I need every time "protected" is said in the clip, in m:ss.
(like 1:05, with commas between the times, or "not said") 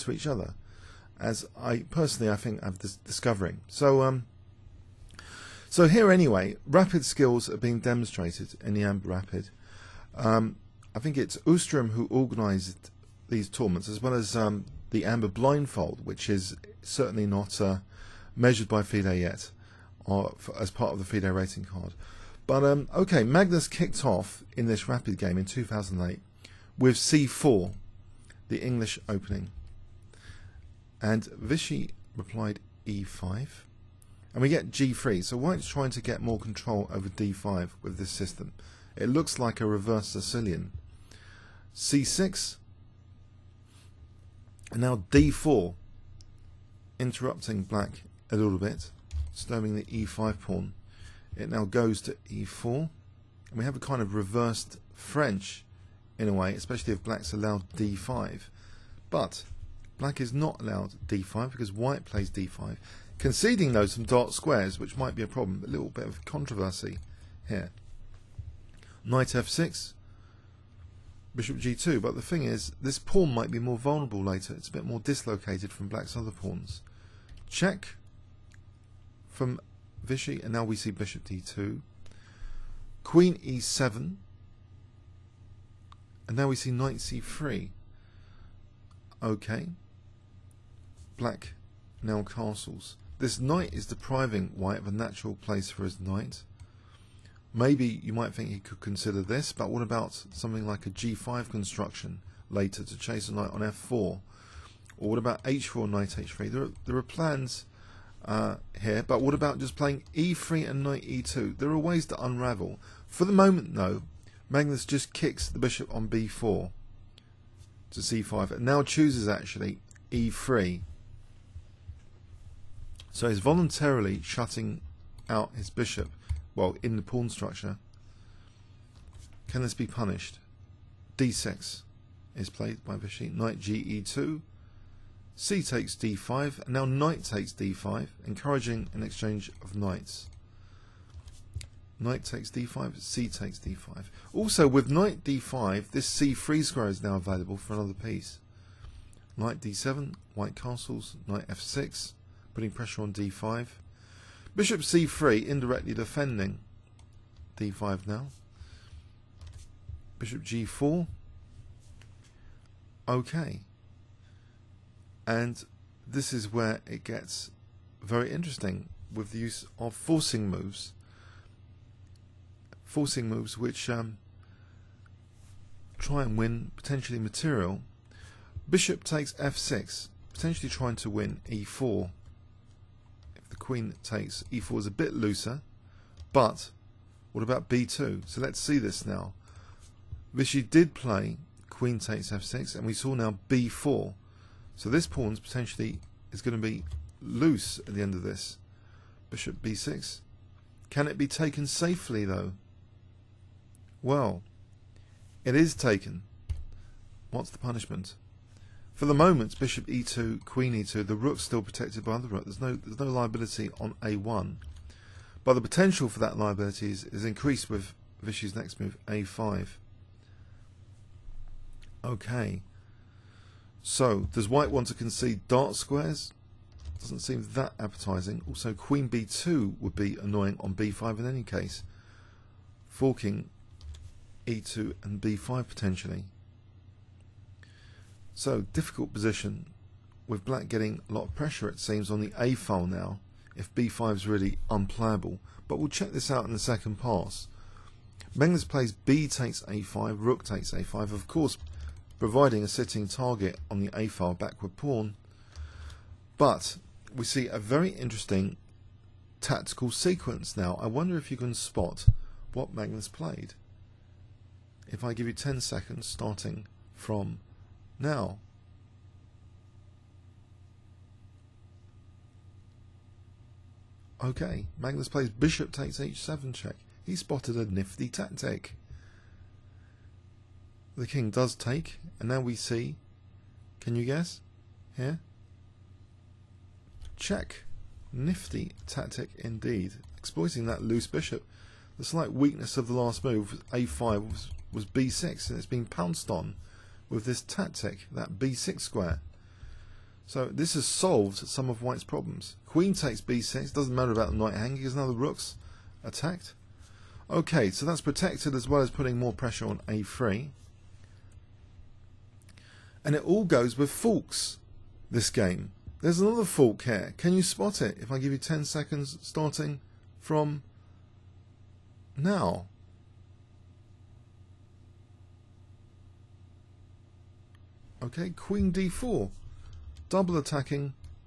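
3:31, 5:08.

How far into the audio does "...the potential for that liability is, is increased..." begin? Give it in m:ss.
3:35.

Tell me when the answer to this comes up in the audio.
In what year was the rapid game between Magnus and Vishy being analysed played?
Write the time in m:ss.
0:25.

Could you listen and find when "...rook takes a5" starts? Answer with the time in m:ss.
4:10.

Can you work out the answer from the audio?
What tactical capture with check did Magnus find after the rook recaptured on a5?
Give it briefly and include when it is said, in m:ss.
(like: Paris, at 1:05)
Bishop takes h7 check, at 4:35.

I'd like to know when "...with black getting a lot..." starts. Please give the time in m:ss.
4:00.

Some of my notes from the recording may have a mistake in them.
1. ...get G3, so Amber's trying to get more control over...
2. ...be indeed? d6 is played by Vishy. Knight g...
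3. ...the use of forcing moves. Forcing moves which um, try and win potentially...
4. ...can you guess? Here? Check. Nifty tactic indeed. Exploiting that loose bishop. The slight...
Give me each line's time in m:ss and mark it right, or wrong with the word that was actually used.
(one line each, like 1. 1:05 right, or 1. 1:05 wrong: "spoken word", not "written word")
1. 0:34 wrong: "White", not "Amber"
2. 2:09 wrong: "punished", not "indeed"
3. 2:49 right
4. 4:43 right.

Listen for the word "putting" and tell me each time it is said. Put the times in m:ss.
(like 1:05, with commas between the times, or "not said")
2:32, 5:08.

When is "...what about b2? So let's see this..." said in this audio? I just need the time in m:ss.
3:07.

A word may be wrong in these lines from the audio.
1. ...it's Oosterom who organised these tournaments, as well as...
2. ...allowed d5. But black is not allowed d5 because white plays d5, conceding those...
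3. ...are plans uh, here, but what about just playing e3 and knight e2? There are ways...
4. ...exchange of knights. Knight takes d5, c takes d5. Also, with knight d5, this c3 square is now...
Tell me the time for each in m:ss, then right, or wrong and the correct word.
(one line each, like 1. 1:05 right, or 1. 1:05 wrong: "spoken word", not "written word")
1. 0:11 right
2. 0:57 right
3. 1:46 right
4. 2:19 right.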